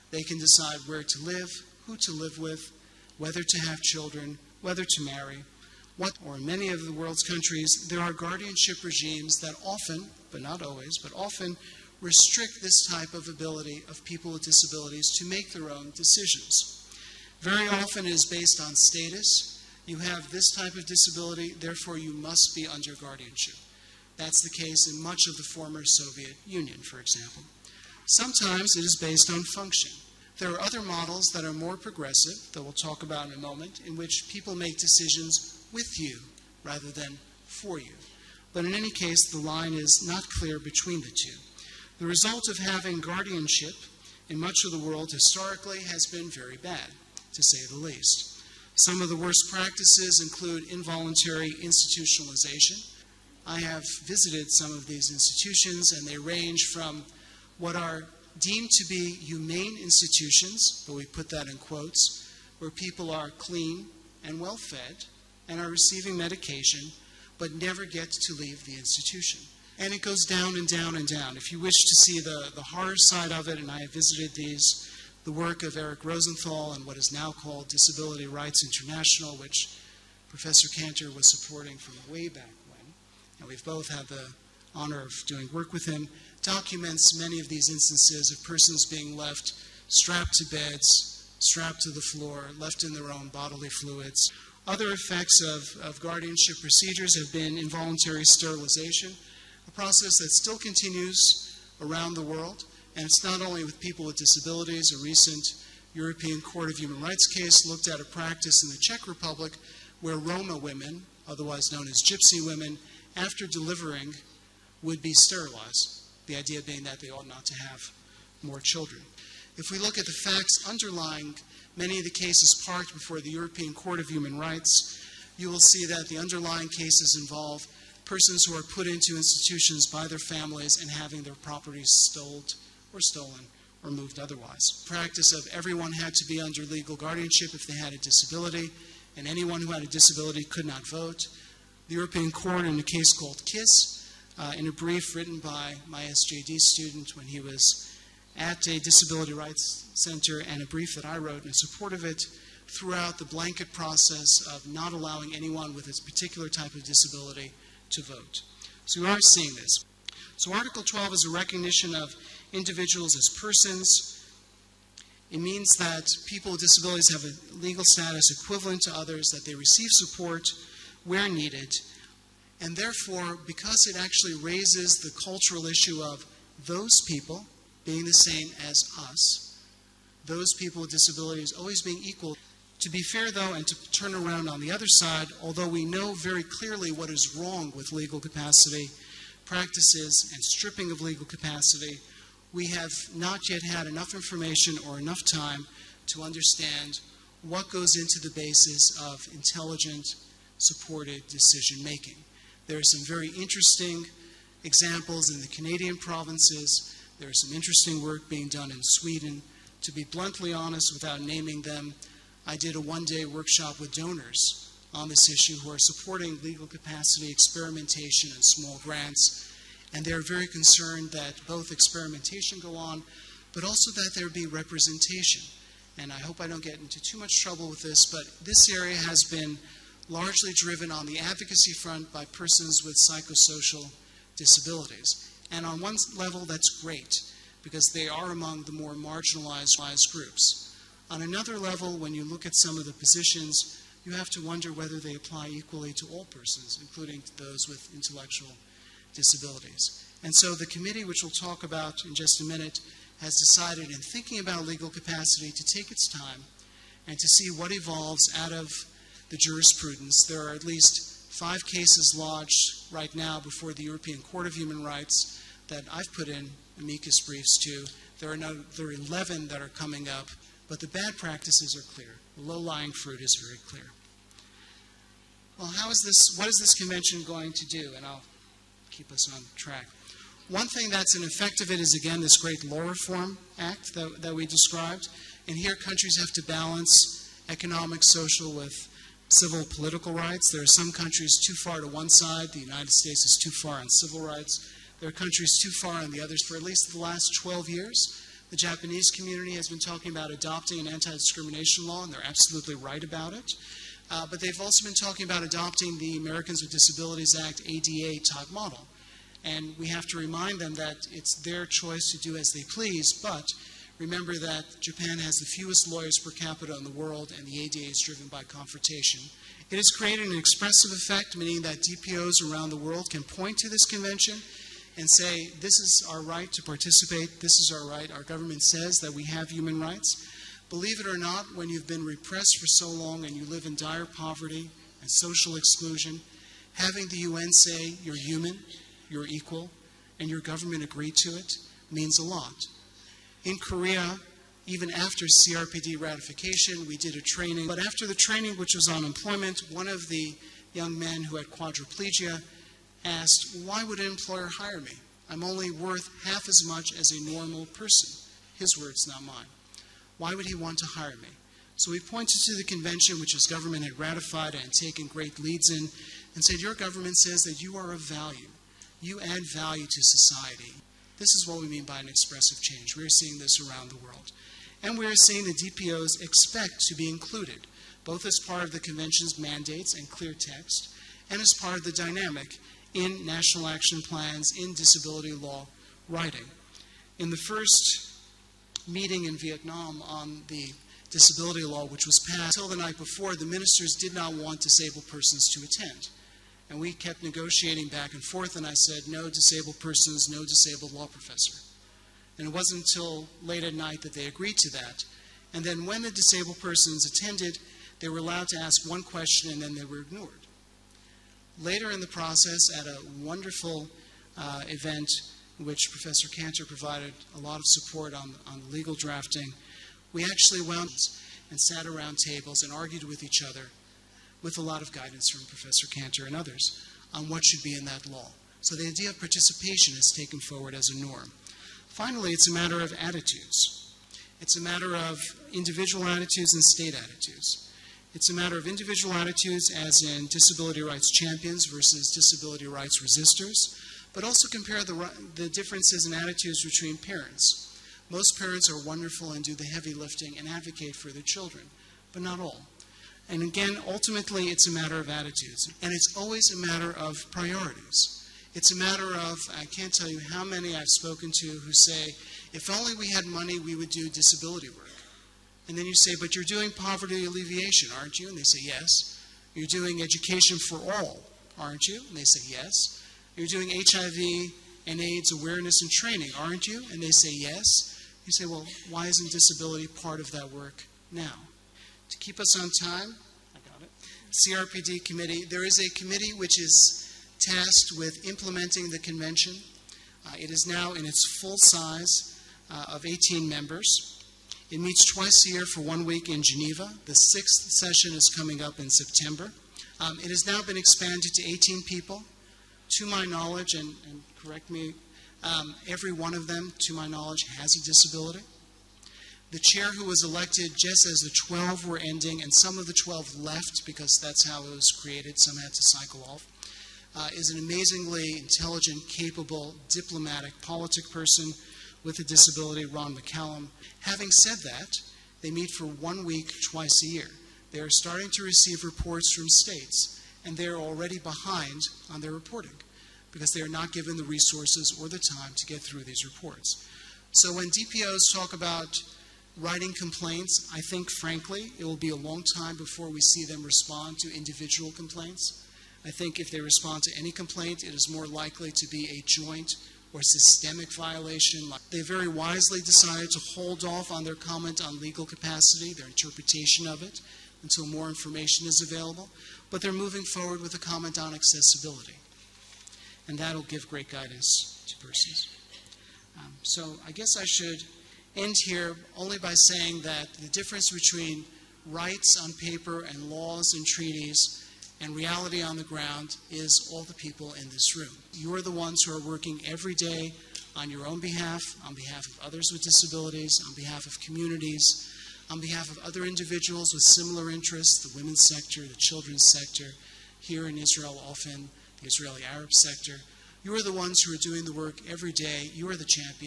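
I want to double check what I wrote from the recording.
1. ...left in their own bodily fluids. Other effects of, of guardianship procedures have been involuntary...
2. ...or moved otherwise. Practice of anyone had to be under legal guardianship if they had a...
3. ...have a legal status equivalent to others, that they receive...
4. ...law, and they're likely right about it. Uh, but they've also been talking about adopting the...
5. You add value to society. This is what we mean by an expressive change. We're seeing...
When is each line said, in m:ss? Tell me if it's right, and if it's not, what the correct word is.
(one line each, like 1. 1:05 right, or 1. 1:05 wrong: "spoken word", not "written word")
1. 1:32 right
2. 2:13 wrong: "everyone", not "anyone"
3. 2:47 right
4. 5:01 wrong: "absolutely", not "likely"
5. 6:09 right.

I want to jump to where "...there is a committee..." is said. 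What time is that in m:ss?
8:05.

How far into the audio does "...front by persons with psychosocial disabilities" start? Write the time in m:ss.
3:51.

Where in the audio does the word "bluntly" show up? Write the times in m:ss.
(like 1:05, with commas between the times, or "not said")
3:30.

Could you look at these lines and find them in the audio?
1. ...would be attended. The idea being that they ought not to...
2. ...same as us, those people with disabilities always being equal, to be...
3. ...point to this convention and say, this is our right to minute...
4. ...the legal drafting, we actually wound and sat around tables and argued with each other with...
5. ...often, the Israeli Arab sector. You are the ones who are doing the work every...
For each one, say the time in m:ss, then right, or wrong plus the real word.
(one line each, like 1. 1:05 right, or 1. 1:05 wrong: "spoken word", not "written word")
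1. 1:54 wrong: "sterilized", not "attended"
2. 2:58 right
3. 5:23 wrong: "participate", not "minute"
4. 6:58 right
5. 9:51 right.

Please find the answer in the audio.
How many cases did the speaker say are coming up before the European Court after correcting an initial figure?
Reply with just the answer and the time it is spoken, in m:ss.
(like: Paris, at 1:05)
11, at 4:28.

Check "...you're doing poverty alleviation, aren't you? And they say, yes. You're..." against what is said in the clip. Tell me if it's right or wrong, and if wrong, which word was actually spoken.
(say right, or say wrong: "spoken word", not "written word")
right.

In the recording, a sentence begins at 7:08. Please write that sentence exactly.
So the idea of participation is taken forward as a norm.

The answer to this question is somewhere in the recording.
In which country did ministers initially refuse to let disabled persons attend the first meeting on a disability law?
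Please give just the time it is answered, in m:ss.
6:29.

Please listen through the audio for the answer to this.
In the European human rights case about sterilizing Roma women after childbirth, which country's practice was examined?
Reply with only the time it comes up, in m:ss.
1:48.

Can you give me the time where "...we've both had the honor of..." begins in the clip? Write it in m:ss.
1:23.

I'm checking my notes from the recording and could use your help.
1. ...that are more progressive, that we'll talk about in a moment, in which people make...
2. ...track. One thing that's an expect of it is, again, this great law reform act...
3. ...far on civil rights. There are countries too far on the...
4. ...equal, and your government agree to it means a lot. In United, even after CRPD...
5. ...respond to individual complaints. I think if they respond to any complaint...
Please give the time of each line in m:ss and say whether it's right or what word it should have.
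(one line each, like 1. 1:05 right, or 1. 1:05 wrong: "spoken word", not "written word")
1. 0:31 right
2. 4:39 wrong: "effect", not "expect"
3. 4:53 right
4. 5:39 wrong: "Korea", not "United"
5. 9:03 right.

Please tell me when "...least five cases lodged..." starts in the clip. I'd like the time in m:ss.
4:20.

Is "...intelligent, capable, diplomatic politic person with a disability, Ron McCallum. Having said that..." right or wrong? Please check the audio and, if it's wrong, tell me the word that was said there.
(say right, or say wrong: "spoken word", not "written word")
right.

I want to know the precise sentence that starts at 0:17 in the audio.
Very often it is based on status, you have this type of disability, therefore you must be under guardianship.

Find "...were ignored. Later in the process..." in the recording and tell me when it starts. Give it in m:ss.
6:49.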